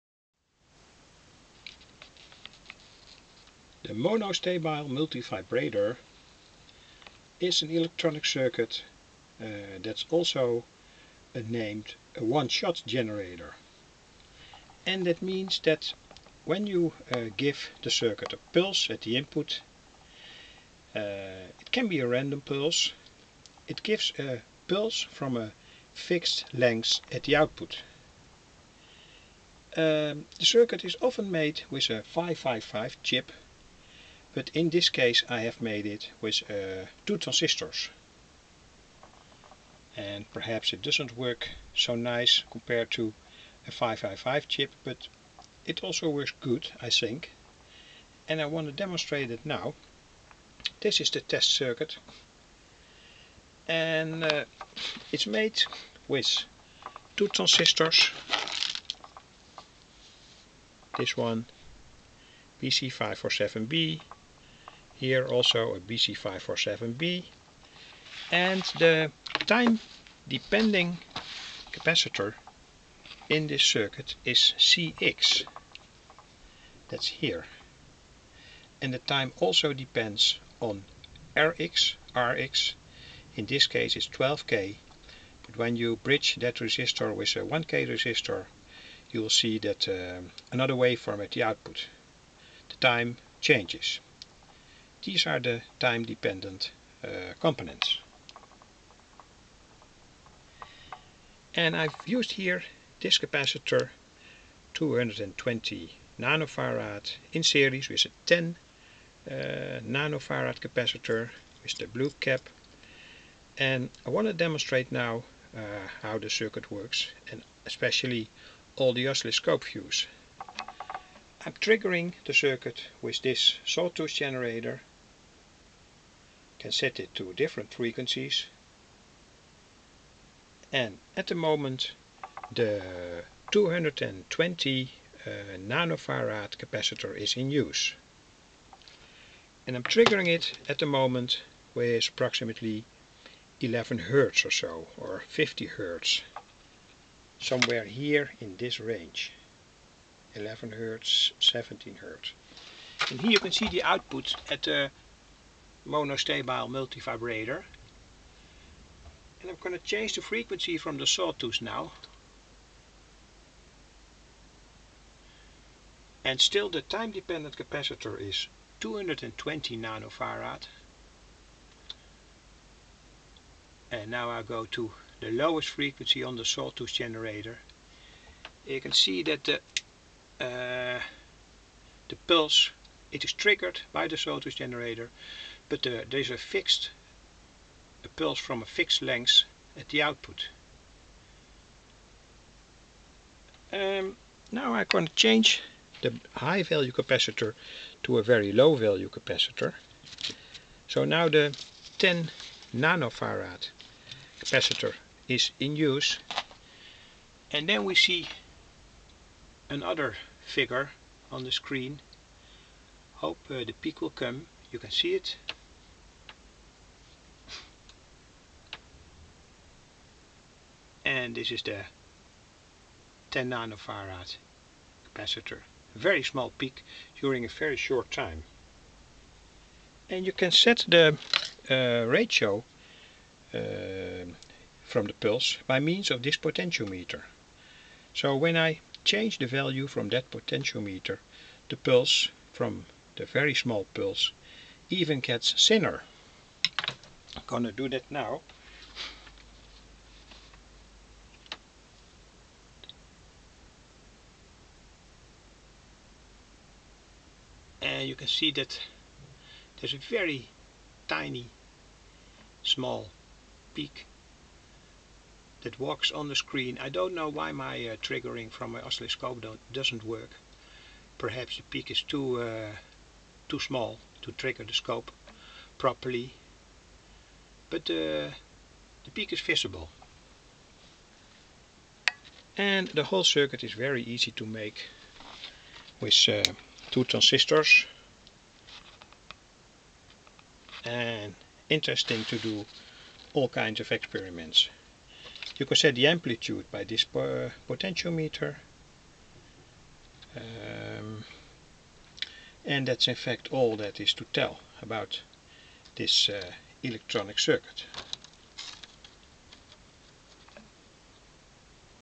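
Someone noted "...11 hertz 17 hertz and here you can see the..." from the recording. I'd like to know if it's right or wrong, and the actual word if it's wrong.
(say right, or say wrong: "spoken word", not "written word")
right.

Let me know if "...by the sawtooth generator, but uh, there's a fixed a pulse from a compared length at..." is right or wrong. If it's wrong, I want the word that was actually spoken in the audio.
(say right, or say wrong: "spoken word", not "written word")
wrong: "fixed", not "compared".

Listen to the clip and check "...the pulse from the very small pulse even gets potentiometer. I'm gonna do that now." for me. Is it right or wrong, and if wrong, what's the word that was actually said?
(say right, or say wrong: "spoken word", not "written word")
wrong: "thinner", not "potentiometer".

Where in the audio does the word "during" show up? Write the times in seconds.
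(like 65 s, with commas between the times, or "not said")
227 s.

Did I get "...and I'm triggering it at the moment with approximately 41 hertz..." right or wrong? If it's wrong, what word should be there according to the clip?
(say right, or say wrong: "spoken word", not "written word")
wrong: "11", not "41".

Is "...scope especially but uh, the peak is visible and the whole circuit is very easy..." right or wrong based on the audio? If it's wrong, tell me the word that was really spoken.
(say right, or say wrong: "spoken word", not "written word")
wrong: "properly", not "especially".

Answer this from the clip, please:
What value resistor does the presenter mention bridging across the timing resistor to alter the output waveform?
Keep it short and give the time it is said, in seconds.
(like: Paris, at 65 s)
1k, at 87 s.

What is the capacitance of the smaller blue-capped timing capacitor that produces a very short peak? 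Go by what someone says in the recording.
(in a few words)
10 nanofarad.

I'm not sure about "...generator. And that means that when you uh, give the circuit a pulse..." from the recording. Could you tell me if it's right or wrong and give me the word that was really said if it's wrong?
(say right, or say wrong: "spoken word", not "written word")
right.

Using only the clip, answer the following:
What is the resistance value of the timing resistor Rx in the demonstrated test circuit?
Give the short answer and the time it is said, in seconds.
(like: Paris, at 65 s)
12k, at 84 s.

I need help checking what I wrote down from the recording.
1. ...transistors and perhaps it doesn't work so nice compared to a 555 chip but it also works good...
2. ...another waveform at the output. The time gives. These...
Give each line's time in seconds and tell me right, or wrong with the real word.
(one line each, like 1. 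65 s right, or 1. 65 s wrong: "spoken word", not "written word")
1. 37 s right
2. 90 s wrong: "changes", not "gives".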